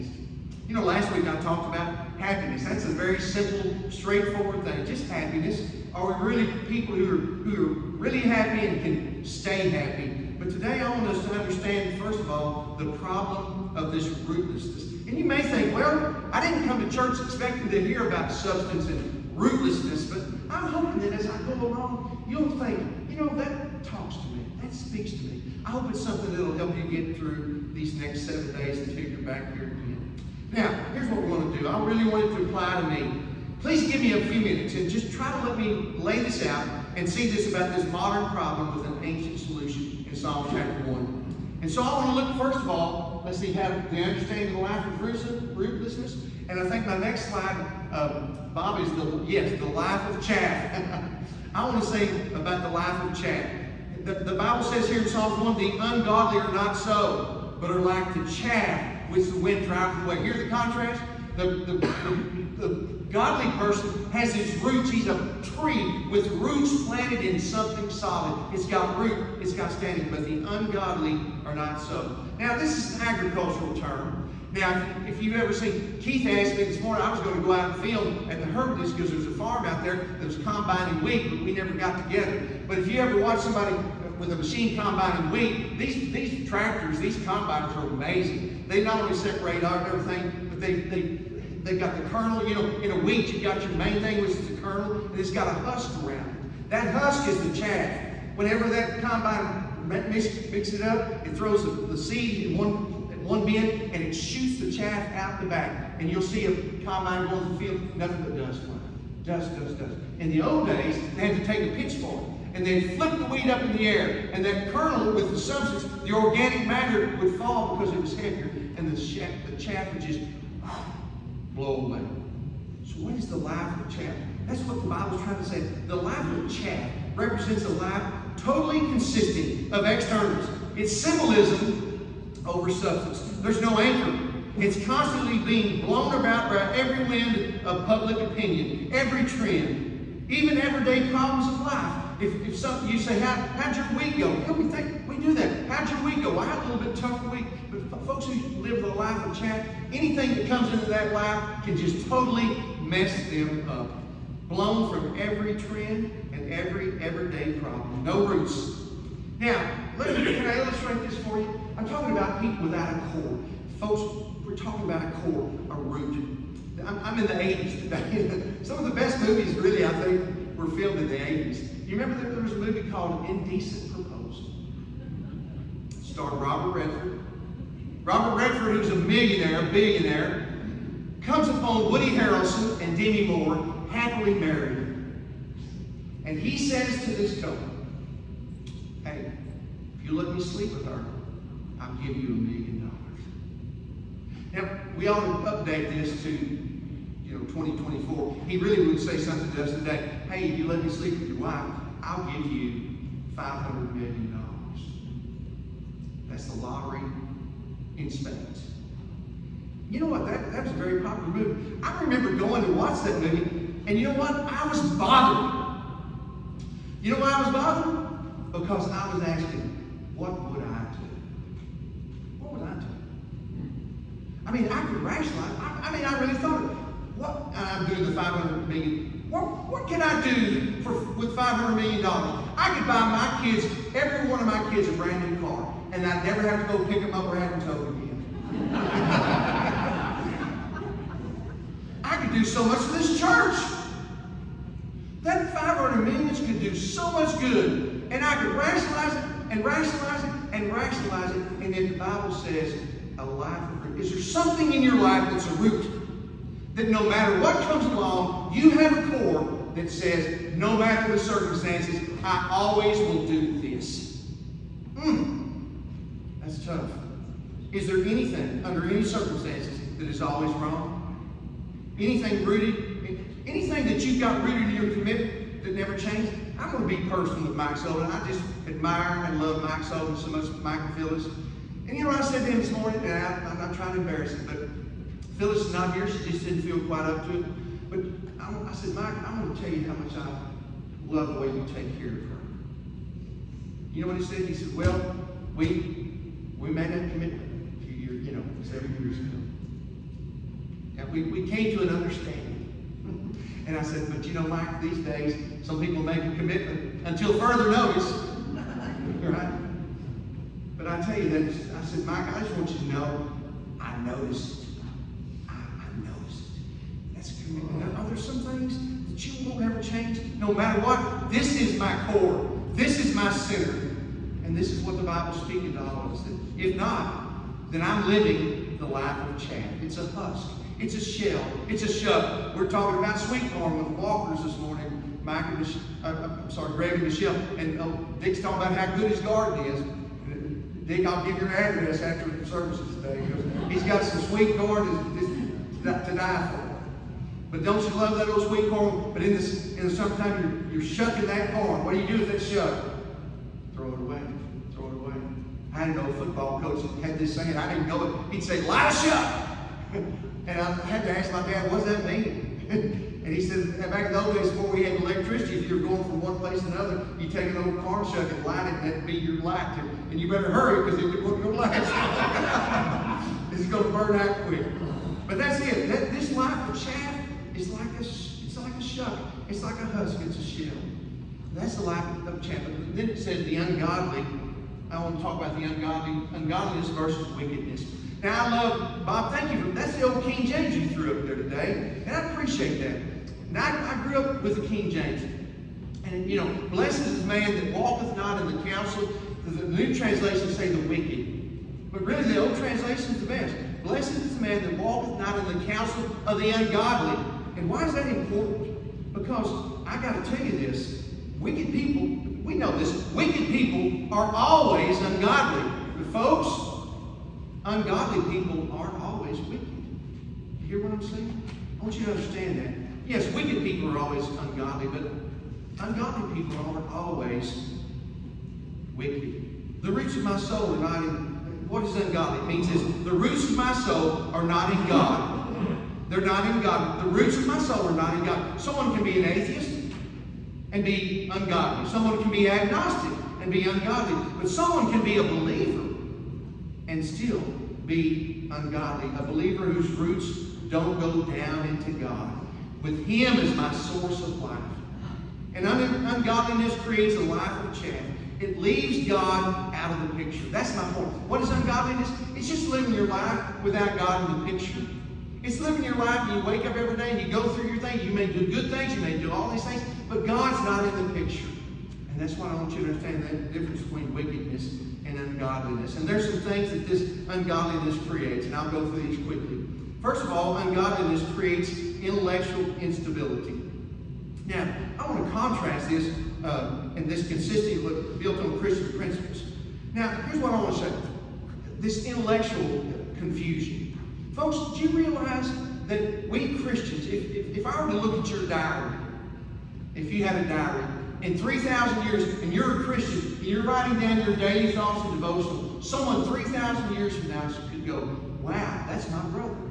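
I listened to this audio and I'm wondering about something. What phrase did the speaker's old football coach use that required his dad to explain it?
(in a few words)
Light a shuck.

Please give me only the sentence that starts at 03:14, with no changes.
Now, we ought to update this to know, 2024, he really would say something to us today.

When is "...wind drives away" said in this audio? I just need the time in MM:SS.
00:59.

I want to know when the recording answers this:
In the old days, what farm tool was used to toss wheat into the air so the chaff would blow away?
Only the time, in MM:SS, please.
01:51.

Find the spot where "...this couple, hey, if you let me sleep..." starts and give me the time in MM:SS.
03:07.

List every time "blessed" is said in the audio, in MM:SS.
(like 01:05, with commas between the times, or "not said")
06:36, 06:43.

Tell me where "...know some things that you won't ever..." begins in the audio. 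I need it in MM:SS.
05:17.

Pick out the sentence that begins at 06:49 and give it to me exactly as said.
Because I got to tell you this, wicked people, we know this, wicked people are always ungodly.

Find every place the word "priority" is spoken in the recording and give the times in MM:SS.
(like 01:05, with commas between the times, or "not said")
not said.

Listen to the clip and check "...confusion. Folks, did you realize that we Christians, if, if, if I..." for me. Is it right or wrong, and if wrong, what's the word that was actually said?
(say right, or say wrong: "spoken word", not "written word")
right.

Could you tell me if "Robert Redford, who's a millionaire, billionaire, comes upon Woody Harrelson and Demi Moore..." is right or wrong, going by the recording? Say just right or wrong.
right.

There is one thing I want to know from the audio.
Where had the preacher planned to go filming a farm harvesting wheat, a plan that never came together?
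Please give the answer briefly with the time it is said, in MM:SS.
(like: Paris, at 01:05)
The Hermitage, at 01:18.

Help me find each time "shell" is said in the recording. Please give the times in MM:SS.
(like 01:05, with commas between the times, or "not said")
05:30, 06:20.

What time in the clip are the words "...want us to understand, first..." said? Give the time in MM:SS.
00:10.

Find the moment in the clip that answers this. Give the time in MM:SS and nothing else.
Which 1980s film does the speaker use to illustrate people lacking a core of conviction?
02:53.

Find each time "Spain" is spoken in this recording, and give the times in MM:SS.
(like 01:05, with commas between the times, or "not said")
03:28.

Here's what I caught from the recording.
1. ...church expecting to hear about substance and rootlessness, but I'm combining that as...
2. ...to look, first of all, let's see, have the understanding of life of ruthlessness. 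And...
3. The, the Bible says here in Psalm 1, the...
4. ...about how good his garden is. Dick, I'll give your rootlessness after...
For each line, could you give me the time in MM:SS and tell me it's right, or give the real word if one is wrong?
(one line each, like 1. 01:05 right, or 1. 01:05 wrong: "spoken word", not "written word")
1. 00:16 wrong: "hoping", not "combining"
2. 00:42 right
3. 00:54 right
4. 05:38 wrong: "address", not "rootlessness".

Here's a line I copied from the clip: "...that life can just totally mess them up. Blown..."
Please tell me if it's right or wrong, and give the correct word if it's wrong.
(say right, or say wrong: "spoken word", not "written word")
right.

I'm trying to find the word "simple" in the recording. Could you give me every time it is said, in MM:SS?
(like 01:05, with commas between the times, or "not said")
00:03.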